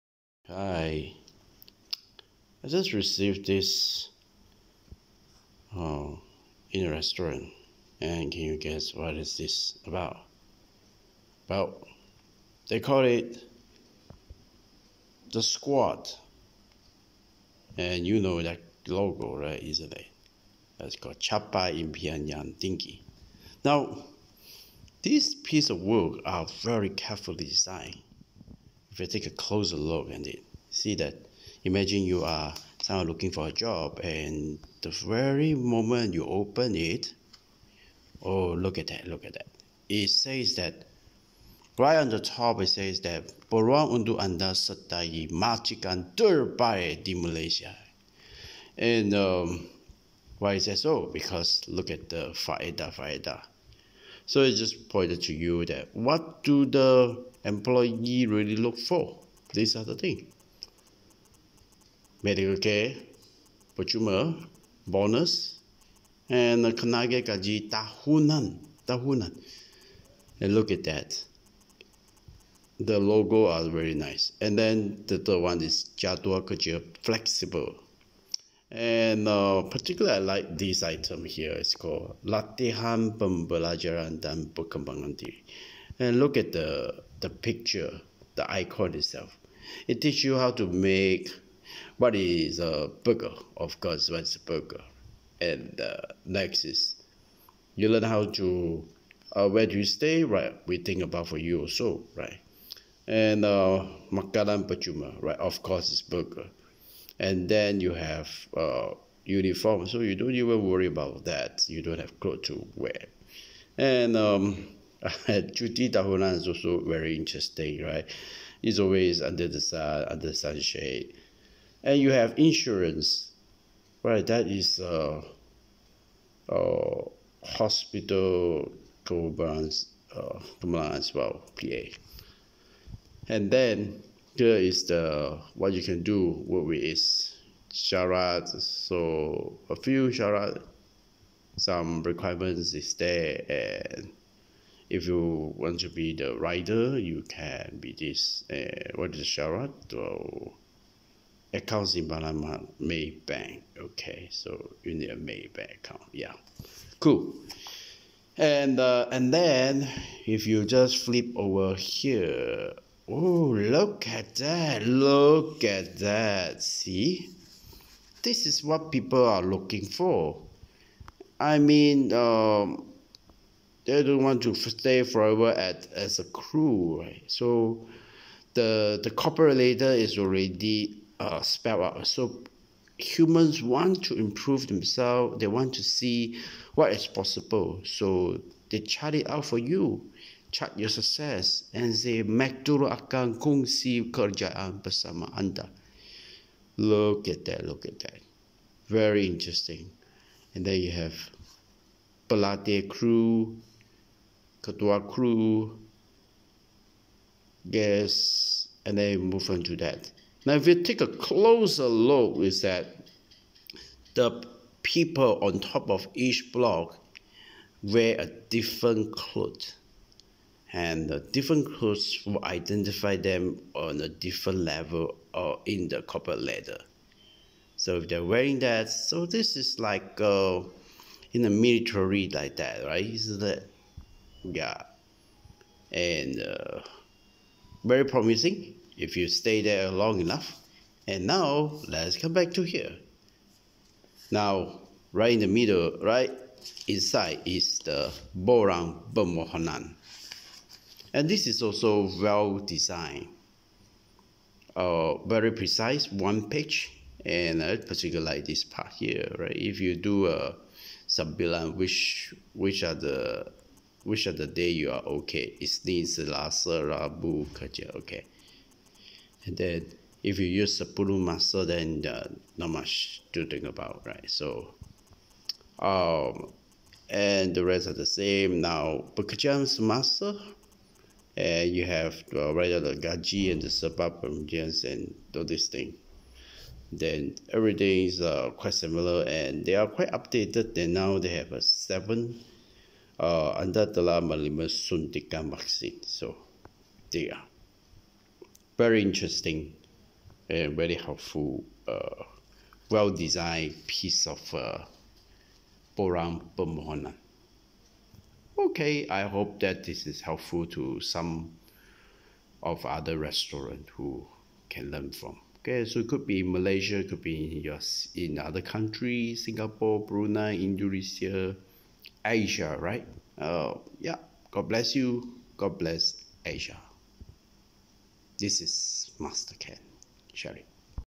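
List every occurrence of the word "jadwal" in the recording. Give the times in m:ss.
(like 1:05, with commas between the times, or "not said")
1:15.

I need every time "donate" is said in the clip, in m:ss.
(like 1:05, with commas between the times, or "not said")
not said.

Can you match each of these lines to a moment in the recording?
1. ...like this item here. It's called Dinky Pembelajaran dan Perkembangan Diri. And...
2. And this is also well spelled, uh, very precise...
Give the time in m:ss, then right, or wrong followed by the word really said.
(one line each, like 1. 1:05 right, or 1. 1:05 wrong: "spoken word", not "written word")
1. 1:20 wrong: "Latihan", not "Dinky"
2. 4:11 wrong: "designed", not "spelled".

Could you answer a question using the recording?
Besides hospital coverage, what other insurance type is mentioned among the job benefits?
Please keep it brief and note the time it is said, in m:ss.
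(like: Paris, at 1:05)
PA, at 2:11.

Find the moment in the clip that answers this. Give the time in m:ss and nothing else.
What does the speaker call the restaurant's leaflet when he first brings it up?
0:15.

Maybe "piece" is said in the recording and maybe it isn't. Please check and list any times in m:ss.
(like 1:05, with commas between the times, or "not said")
0:25, 5:03.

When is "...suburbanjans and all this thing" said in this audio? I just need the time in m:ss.
4:43.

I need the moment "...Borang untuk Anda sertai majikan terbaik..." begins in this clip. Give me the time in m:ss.
0:43.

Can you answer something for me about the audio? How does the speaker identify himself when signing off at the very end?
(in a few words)
Master Kent.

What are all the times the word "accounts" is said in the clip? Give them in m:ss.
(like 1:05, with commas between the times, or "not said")
2:31, 2:35.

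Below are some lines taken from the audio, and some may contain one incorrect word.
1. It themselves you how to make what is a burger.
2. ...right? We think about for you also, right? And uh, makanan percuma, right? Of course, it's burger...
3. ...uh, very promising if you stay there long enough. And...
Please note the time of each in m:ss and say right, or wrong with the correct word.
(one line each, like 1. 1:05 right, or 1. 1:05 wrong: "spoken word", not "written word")
1. 1:29 wrong: "teaches", not "themselves"
2. 1:40 right
3. 3:56 right.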